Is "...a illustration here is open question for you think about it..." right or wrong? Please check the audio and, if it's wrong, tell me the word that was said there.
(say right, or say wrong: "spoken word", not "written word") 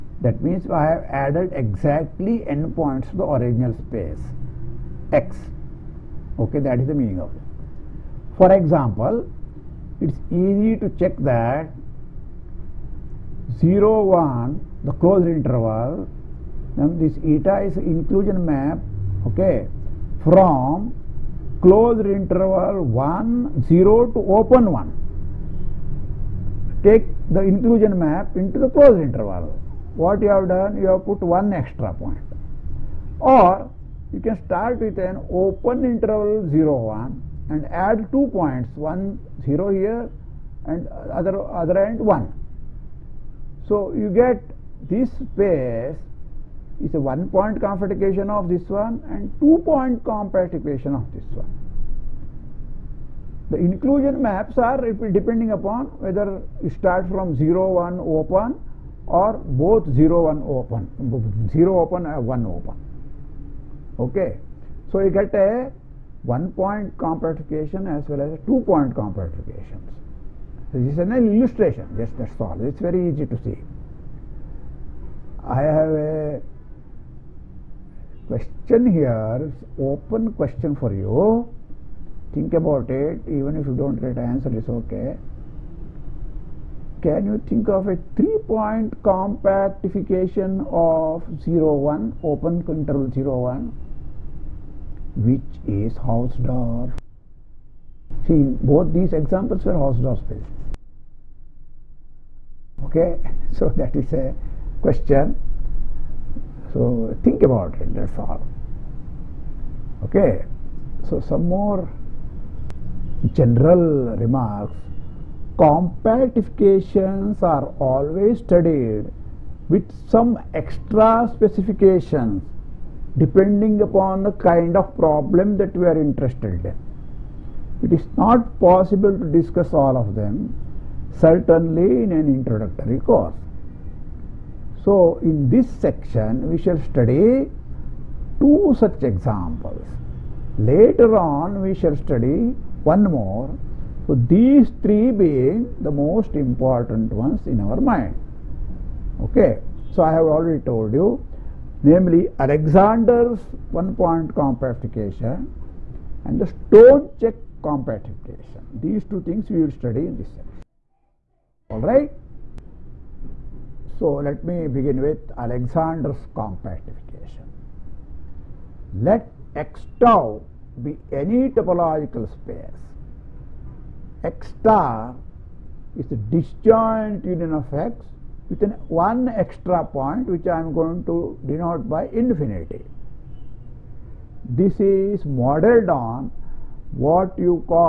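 wrong: "question", not "illustration".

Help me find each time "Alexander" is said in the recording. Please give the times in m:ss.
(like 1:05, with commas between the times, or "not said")
2:32, 2:45.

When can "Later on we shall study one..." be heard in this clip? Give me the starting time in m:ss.
2:20.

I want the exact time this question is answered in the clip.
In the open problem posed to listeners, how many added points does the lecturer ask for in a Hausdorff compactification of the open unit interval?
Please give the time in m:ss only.
1:28.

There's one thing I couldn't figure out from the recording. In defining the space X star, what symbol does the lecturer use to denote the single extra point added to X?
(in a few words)
infinity.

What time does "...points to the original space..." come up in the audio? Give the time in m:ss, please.
0:02.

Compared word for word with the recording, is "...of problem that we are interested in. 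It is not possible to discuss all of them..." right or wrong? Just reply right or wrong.
right.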